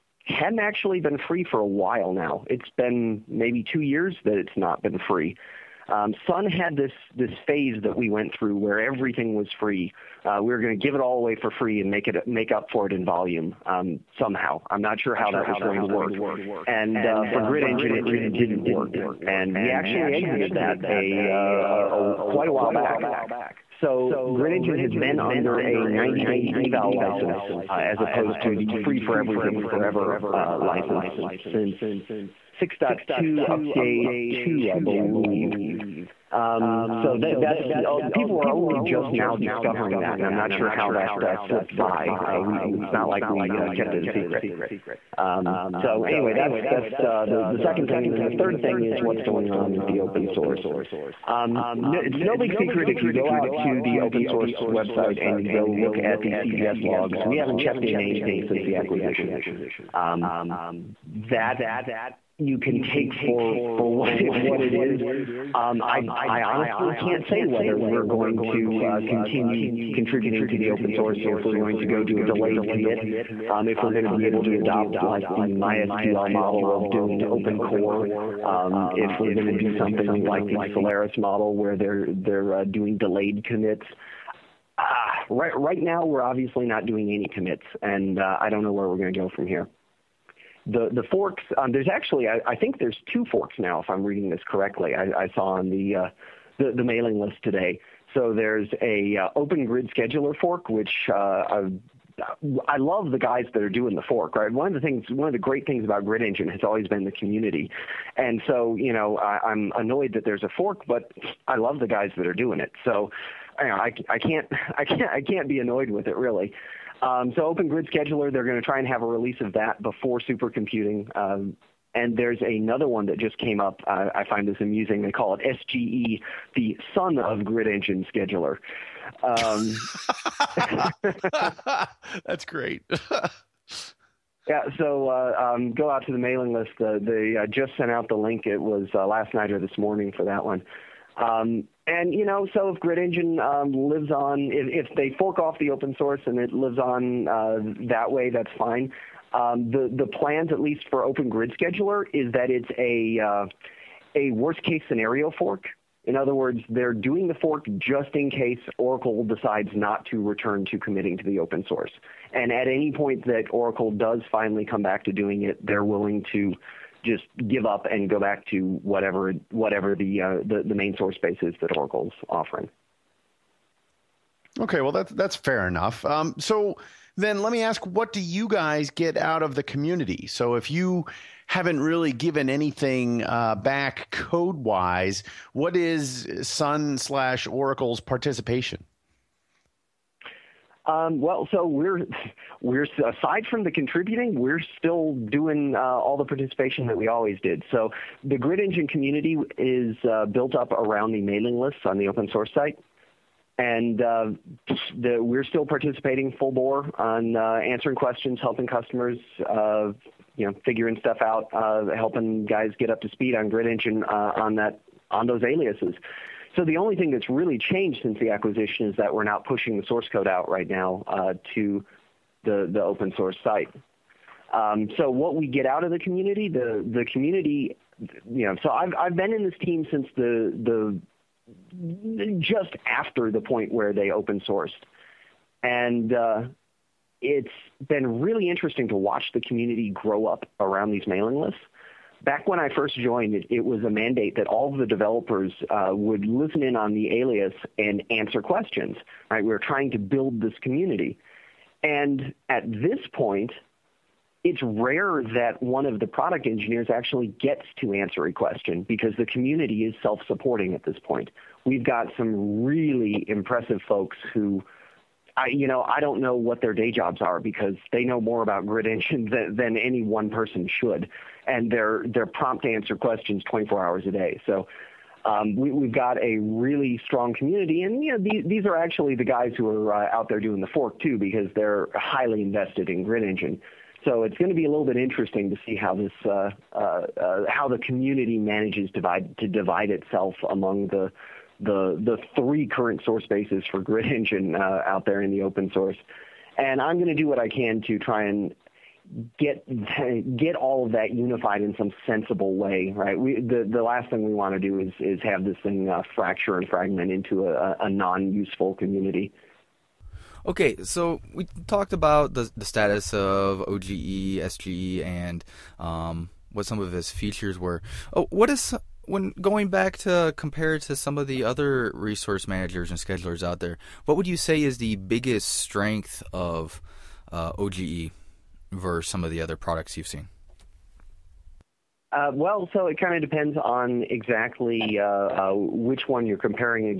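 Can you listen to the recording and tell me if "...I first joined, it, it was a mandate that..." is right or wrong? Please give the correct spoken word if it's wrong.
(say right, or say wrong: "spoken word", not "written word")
right.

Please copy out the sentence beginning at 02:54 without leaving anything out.
Okay, well that's that's fair enough.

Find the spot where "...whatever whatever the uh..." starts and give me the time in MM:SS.
02:48.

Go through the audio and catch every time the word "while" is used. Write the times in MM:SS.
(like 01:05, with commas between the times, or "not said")
00:01, 00:22.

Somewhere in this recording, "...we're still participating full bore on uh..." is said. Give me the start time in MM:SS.
03:25.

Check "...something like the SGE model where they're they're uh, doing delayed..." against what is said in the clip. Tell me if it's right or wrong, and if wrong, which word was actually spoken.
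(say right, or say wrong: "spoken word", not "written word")
wrong: "Solaris", not "SGE".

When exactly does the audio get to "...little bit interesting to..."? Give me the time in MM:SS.
04:44.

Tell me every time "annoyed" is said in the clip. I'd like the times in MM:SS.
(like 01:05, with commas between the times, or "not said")
01:49, 01:55.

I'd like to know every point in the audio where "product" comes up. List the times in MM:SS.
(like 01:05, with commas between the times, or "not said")
04:16, 05:29.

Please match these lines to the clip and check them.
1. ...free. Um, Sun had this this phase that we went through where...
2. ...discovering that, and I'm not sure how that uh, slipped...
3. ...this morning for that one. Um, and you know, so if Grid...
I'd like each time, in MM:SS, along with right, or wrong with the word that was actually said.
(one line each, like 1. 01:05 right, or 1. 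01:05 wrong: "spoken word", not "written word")
1. 00:05 right
2. 00:39 right
3. 02:19 right.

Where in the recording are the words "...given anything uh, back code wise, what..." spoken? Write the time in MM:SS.
03:02.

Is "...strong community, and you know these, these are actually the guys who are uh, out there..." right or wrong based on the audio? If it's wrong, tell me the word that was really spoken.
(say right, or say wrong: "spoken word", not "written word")
right.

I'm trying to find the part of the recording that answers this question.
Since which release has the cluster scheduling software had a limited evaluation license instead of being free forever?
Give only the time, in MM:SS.
00:32.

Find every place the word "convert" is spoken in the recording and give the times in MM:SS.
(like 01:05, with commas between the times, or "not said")
not said.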